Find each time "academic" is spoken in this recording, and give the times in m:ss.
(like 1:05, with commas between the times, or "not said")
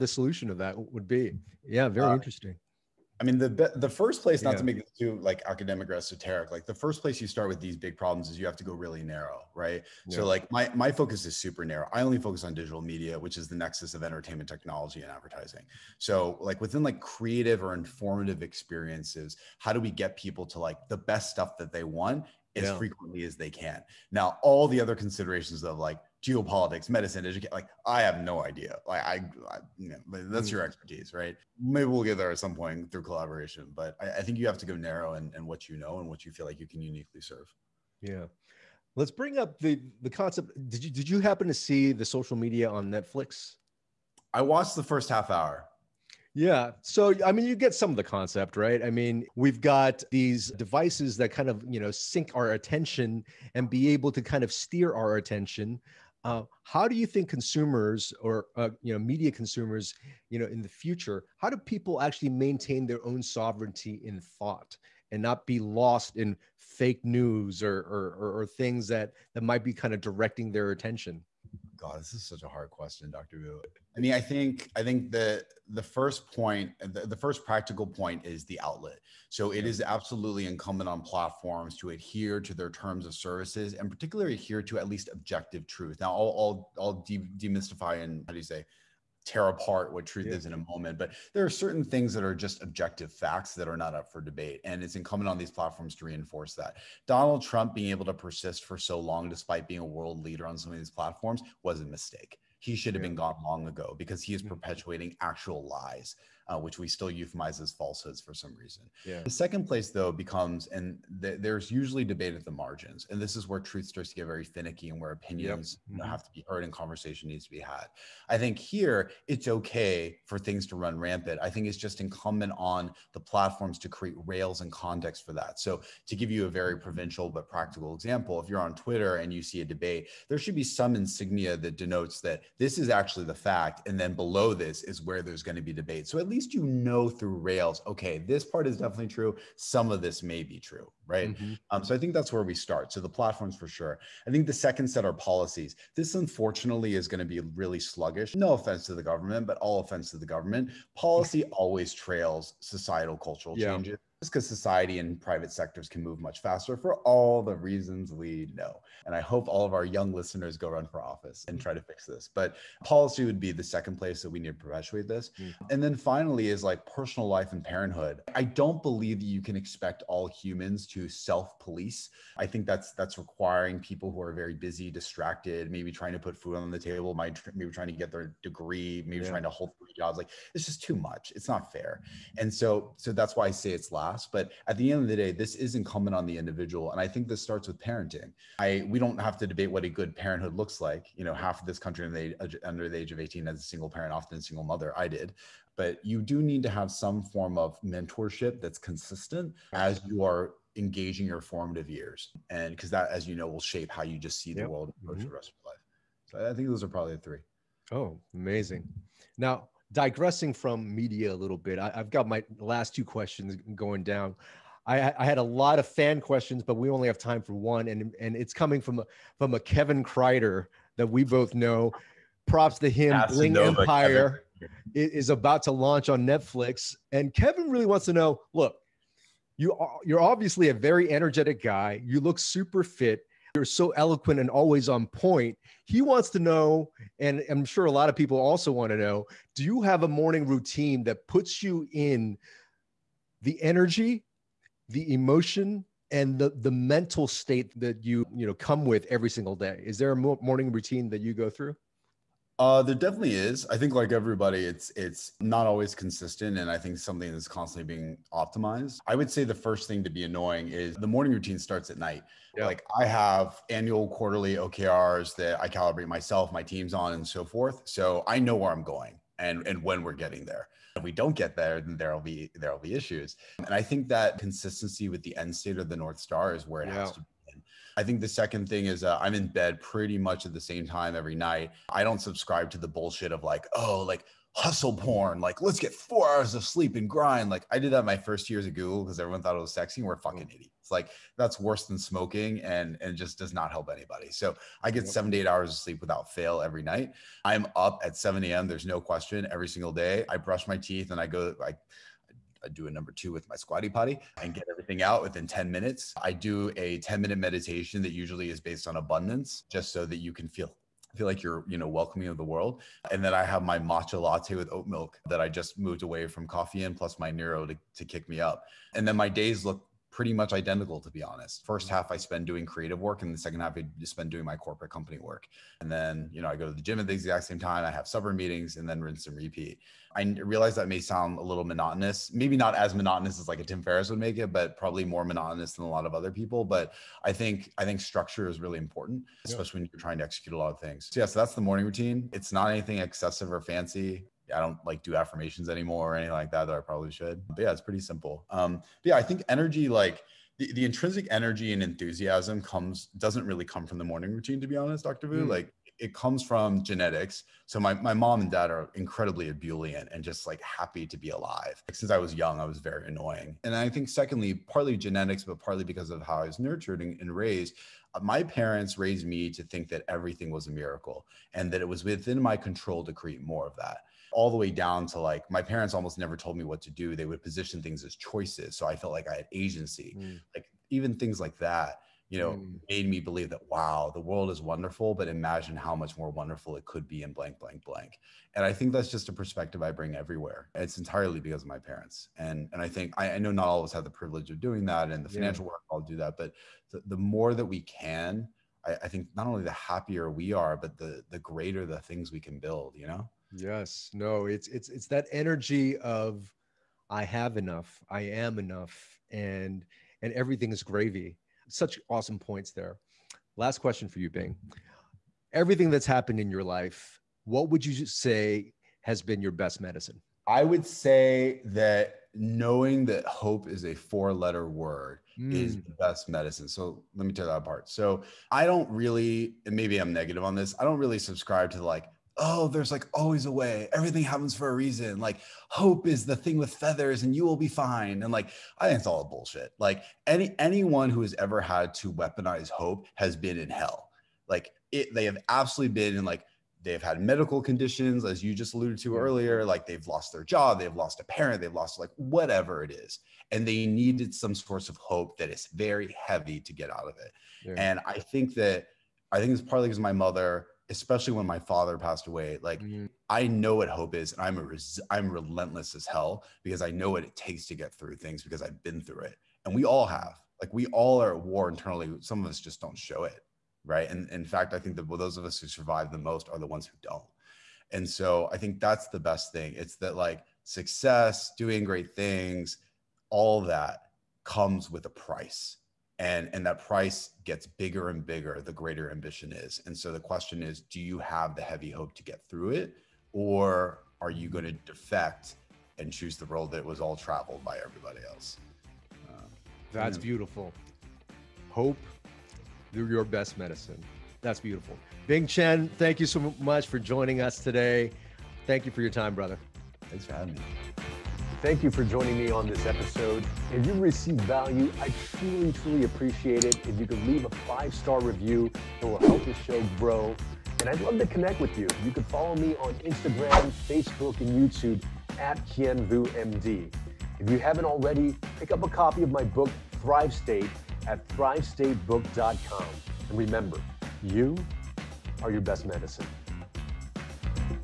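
0:05.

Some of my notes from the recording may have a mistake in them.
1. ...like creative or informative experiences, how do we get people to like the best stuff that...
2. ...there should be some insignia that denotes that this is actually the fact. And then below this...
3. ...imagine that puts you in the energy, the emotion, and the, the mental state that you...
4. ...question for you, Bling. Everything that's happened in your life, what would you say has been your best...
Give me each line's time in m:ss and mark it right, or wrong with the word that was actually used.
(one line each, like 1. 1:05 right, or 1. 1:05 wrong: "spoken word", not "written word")
1. 0:16 right
2. 2:10 right
3. 4:00 wrong: "routine", not "imagine"
4. 6:53 wrong: "Bing", not "Bling".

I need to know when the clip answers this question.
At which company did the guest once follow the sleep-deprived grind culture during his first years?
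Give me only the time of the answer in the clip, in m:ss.
4:48.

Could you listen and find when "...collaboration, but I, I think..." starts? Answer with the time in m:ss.
0:33.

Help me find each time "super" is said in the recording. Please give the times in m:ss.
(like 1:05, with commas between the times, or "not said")
0:11, 3:52.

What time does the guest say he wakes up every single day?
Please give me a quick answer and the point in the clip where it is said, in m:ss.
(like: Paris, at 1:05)
7 a.m., at 4:58.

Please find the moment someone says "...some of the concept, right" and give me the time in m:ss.
0:47.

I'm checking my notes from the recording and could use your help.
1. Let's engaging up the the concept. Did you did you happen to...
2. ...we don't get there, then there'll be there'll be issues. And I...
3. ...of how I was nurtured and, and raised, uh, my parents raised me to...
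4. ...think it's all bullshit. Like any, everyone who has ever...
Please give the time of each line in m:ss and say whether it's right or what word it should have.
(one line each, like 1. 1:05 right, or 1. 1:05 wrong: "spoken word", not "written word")
1. 0:38 wrong: "bring", not "engaging"
2. 4:31 right
3. 6:06 right
4. 7:18 wrong: "anyone", not "everyone".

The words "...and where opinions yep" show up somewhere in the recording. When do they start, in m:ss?
1:54.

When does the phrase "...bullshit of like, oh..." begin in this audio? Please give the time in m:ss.
4:42.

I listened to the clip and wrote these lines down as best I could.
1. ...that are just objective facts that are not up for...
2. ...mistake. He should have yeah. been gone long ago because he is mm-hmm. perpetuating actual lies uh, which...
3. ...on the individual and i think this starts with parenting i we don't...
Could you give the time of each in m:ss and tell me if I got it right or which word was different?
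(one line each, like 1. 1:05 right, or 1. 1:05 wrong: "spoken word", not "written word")
1. 1:32 right
2. 1:41 right
3. 3:06 right.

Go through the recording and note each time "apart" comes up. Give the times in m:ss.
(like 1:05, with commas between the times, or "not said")
1:29, 7:07.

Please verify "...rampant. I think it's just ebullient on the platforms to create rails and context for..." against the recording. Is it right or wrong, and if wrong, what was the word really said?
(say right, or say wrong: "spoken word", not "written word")
wrong: "incumbent", not "ebullient".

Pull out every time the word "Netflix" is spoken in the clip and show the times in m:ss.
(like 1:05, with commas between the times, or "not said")
0:42, 3:46.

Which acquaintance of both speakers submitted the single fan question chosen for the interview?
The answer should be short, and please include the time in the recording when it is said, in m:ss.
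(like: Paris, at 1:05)
Kevin Kreider, at 3:39.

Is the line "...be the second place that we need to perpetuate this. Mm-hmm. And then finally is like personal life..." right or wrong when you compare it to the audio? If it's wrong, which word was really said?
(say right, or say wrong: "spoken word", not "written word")
right.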